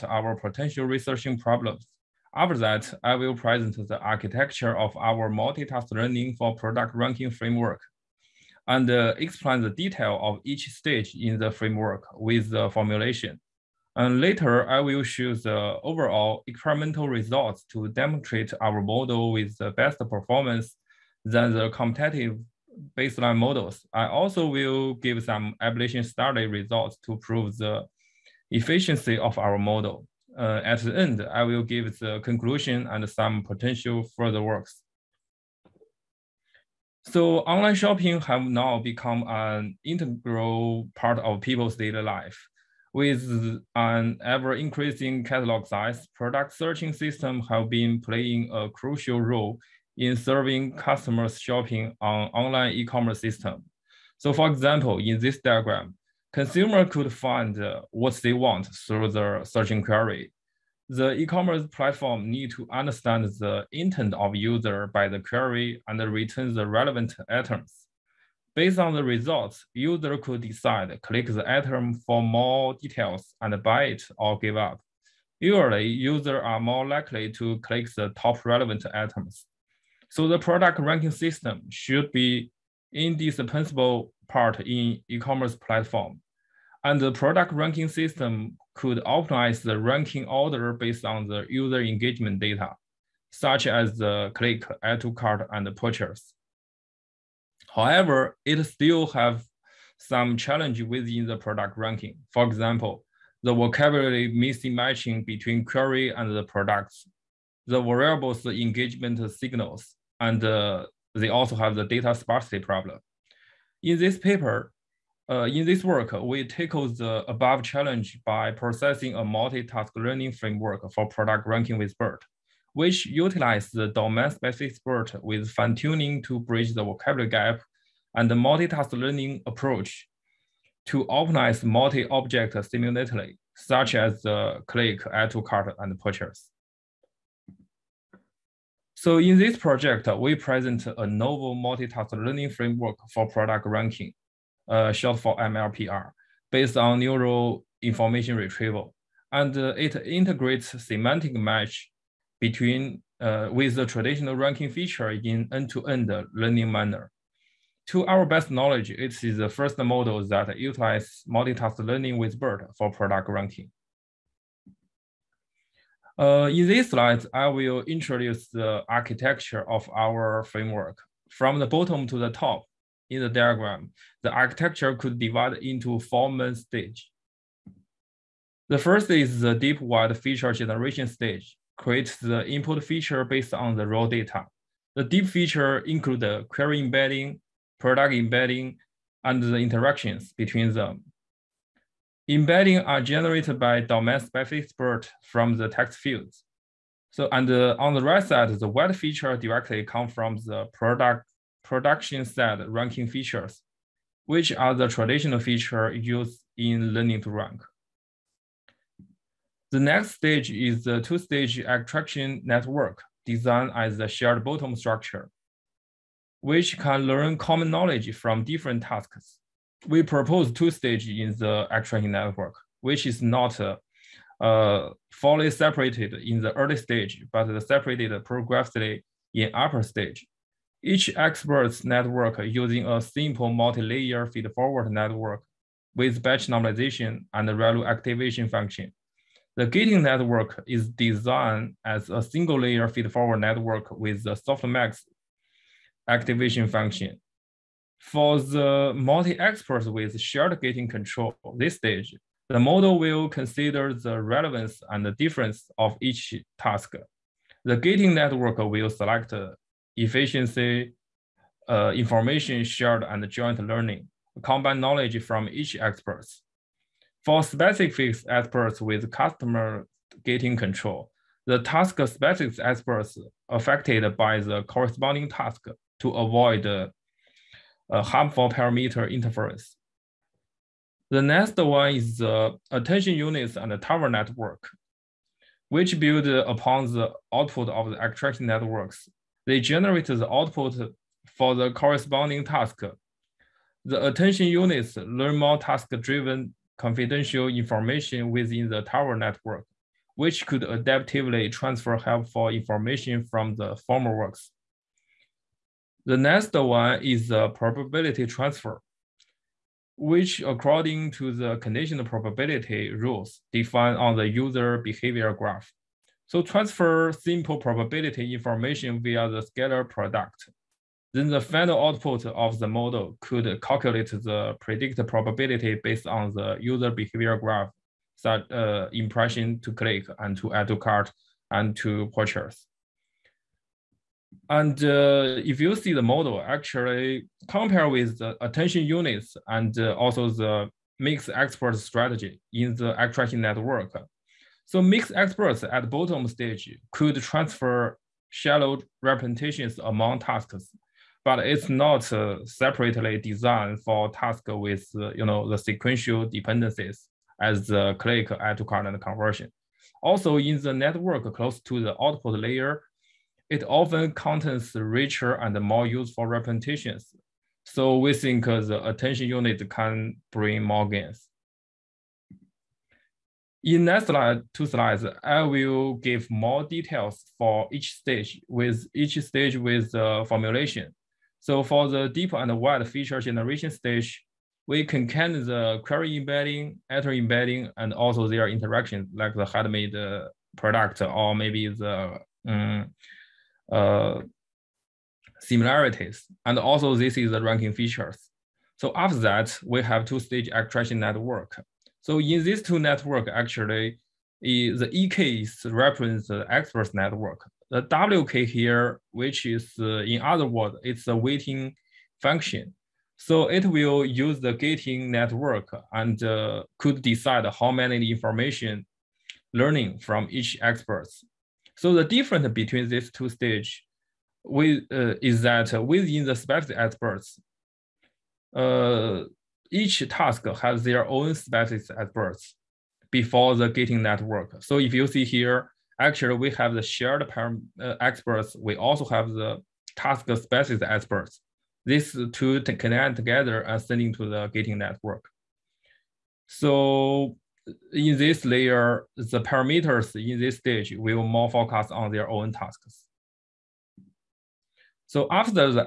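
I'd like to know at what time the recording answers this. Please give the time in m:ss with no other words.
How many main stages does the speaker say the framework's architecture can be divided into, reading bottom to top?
2:55.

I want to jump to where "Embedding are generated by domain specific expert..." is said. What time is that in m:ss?
3:12.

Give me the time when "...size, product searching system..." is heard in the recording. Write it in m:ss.
0:45.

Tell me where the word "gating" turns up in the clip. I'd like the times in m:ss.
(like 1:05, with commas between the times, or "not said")
3:59, 4:10, 4:17, 4:30, 6:54, 7:13, 7:24.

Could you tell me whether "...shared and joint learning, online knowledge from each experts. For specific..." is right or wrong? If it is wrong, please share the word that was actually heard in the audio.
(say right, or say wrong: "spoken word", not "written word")
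wrong: "combine", not "online".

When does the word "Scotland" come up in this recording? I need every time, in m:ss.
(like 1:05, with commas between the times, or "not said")
not said.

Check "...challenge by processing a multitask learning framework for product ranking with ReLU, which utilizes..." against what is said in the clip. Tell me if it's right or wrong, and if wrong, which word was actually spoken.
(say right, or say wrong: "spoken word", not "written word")
wrong: "BERT", not "ReLU".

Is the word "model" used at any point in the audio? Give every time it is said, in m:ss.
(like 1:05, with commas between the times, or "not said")
0:18, 0:23, 0:29, 2:39, 4:12, 5:22, 5:36.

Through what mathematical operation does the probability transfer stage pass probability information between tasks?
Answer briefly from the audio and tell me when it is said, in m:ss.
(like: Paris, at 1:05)
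scalar product, at 5:19.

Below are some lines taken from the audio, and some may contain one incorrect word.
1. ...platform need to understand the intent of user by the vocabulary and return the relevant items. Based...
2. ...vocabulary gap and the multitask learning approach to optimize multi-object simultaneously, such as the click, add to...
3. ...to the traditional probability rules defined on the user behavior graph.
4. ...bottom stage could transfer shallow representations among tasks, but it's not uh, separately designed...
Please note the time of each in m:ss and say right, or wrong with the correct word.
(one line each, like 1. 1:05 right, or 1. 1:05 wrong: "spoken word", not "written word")
1. 1:01 wrong: "query", not "vocabulary"
2. 2:06 right
3. 5:11 wrong: "conditional", not "traditional"
4. 5:45 right.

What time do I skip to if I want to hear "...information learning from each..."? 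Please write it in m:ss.
6:58.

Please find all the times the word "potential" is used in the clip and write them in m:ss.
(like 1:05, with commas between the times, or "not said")
0:00, 0:33.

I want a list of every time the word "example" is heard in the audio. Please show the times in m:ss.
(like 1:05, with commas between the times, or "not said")
0:54, 1:42.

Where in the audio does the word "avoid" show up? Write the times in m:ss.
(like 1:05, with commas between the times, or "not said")
4:36.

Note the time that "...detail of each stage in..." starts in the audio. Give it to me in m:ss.
0:09.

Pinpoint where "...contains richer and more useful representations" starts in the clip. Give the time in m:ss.
6:04.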